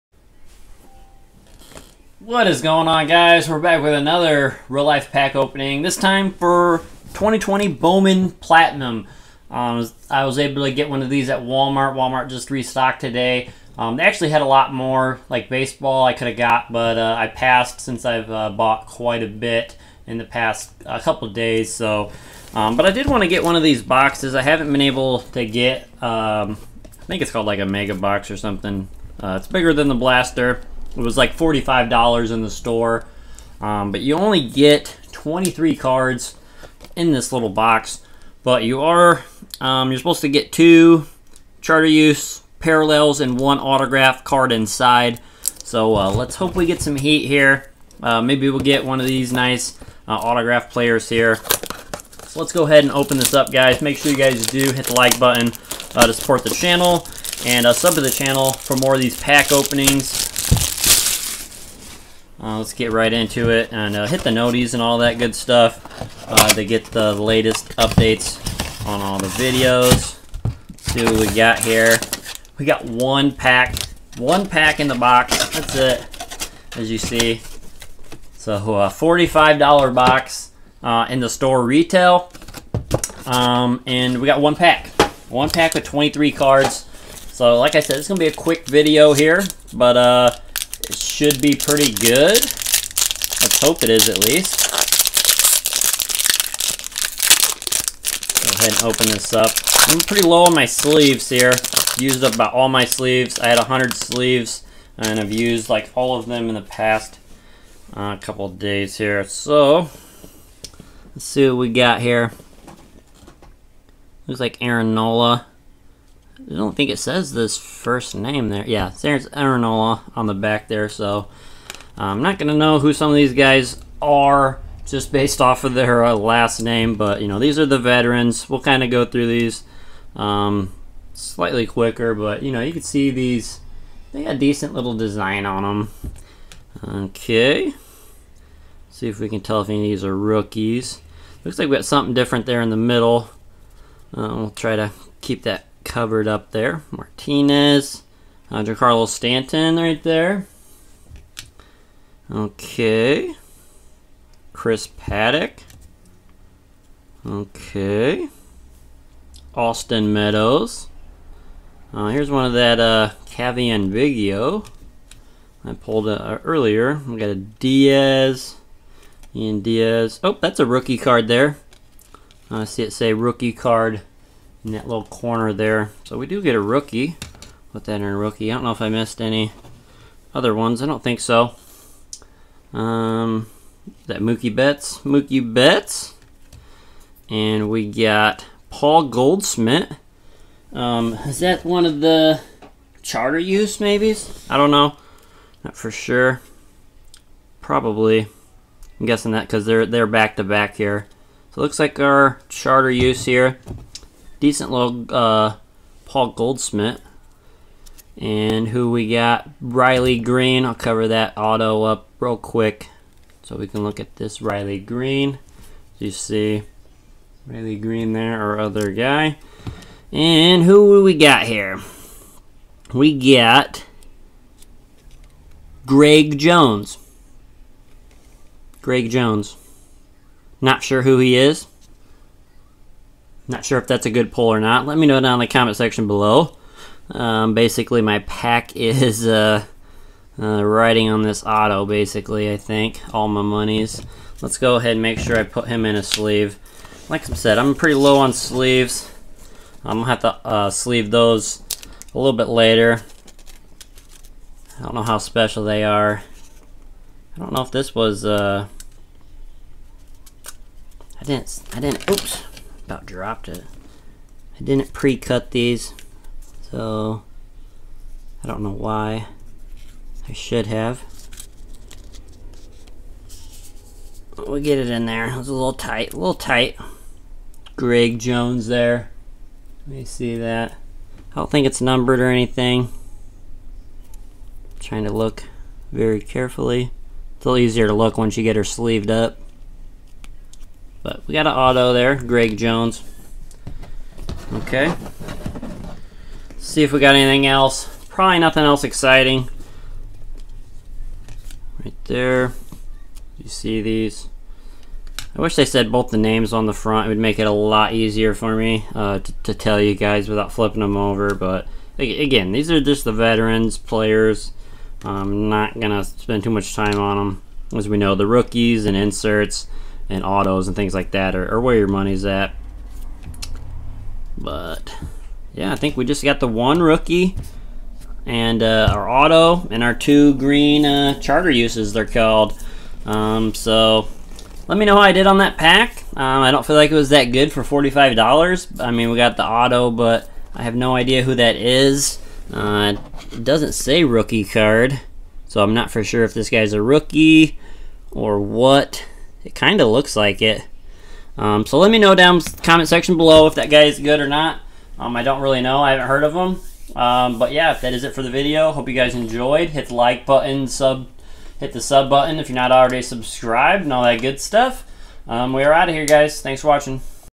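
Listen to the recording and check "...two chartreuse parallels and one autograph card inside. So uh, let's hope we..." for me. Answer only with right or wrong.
right.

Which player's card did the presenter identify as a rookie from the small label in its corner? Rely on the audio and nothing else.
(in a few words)
Ian Diaz.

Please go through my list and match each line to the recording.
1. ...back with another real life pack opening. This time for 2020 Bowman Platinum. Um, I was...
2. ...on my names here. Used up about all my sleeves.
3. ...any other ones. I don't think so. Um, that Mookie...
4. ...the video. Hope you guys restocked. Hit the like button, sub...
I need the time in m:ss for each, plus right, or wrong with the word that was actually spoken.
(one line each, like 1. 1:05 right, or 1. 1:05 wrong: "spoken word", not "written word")
1. 0:03 right
2. 1:40 wrong: "sleeves", not "names"
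3. 2:59 right
4. 5:58 wrong: "enjoyed", not "restocked".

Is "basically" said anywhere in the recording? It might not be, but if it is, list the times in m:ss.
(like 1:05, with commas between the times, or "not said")
3:57, 4:01.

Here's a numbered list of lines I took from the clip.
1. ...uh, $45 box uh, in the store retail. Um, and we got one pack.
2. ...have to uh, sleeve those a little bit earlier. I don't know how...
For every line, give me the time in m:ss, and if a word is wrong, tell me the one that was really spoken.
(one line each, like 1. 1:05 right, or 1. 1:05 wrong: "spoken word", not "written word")
1. 1:18 right
2. 4:10 wrong: "later", not "earlier".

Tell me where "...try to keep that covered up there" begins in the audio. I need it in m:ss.
2:24.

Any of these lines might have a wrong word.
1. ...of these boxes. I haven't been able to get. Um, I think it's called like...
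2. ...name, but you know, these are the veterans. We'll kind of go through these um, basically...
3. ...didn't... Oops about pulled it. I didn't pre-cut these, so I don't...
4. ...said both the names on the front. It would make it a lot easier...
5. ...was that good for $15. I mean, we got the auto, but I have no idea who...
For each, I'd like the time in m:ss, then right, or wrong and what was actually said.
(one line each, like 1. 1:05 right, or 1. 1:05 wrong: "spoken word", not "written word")
1. 0:23 right
2. 2:06 wrong: "slightly", not "basically"
3. 4:21 wrong: "dropped", not "pulled"
4. 5:05 right
5. 5:36 wrong: "45", not "15".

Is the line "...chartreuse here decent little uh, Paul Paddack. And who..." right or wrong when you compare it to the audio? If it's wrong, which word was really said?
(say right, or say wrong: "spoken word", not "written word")
wrong: "Goldschmidt", not "Paddack".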